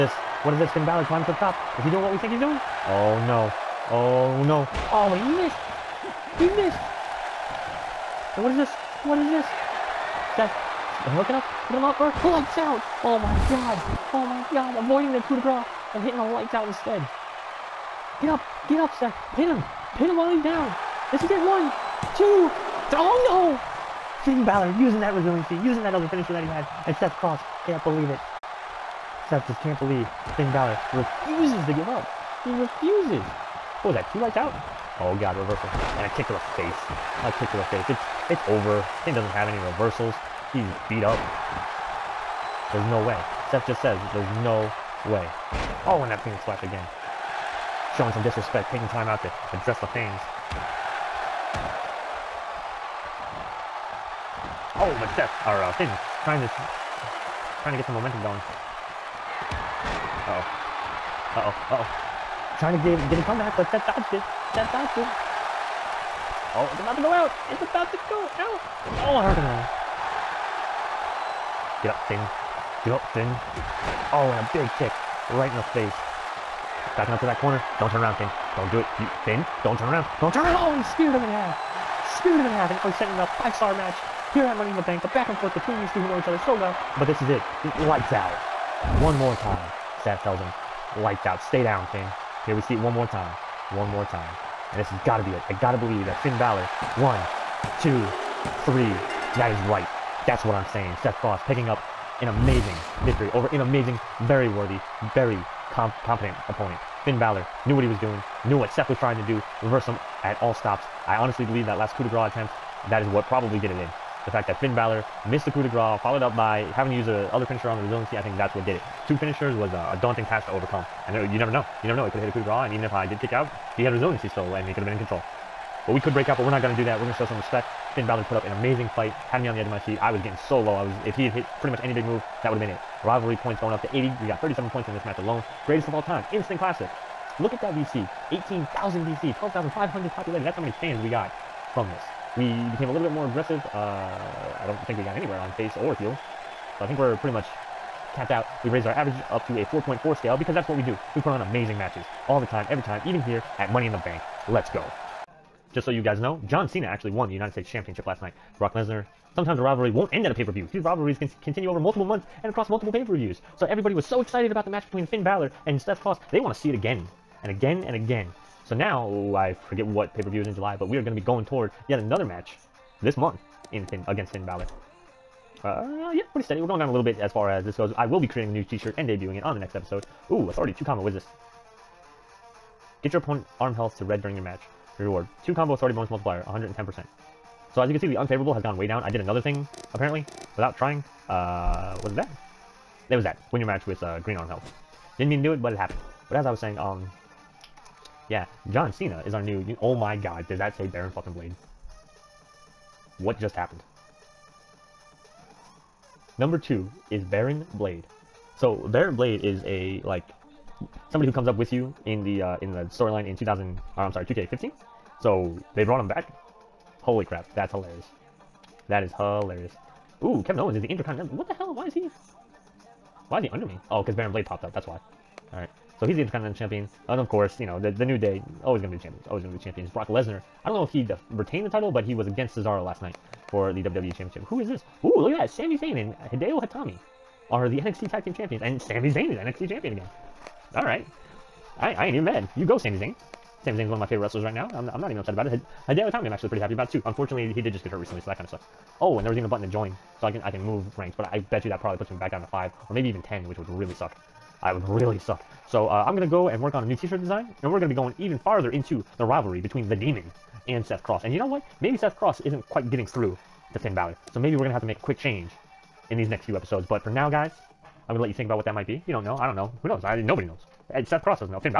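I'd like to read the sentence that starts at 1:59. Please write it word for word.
Two finishers was a daunting task to overcome, and you never know you never know.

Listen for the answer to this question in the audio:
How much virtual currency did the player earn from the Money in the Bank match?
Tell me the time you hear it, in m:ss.
2:18.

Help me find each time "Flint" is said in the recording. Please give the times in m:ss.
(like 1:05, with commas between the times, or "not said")
not said.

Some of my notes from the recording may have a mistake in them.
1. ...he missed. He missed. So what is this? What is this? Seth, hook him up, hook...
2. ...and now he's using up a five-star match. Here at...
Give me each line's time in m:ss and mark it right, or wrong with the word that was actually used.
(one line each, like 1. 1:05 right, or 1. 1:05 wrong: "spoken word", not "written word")
1. 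0:06 right
2. 1:22 wrong: "setting", not "using".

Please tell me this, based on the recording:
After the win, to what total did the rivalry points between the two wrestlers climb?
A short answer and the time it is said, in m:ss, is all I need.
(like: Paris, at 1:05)
80, at 2:13.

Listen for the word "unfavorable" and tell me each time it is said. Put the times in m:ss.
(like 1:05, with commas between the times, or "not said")
3:08.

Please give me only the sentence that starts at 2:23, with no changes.
Uh, I don't think we got anywhere on face or heel.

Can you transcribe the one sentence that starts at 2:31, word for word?
We put on amazing matches all the time, every time, even here at Money in the Bank.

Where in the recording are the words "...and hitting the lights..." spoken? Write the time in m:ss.
0:15.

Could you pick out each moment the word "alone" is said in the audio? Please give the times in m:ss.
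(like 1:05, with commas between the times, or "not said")
2:15.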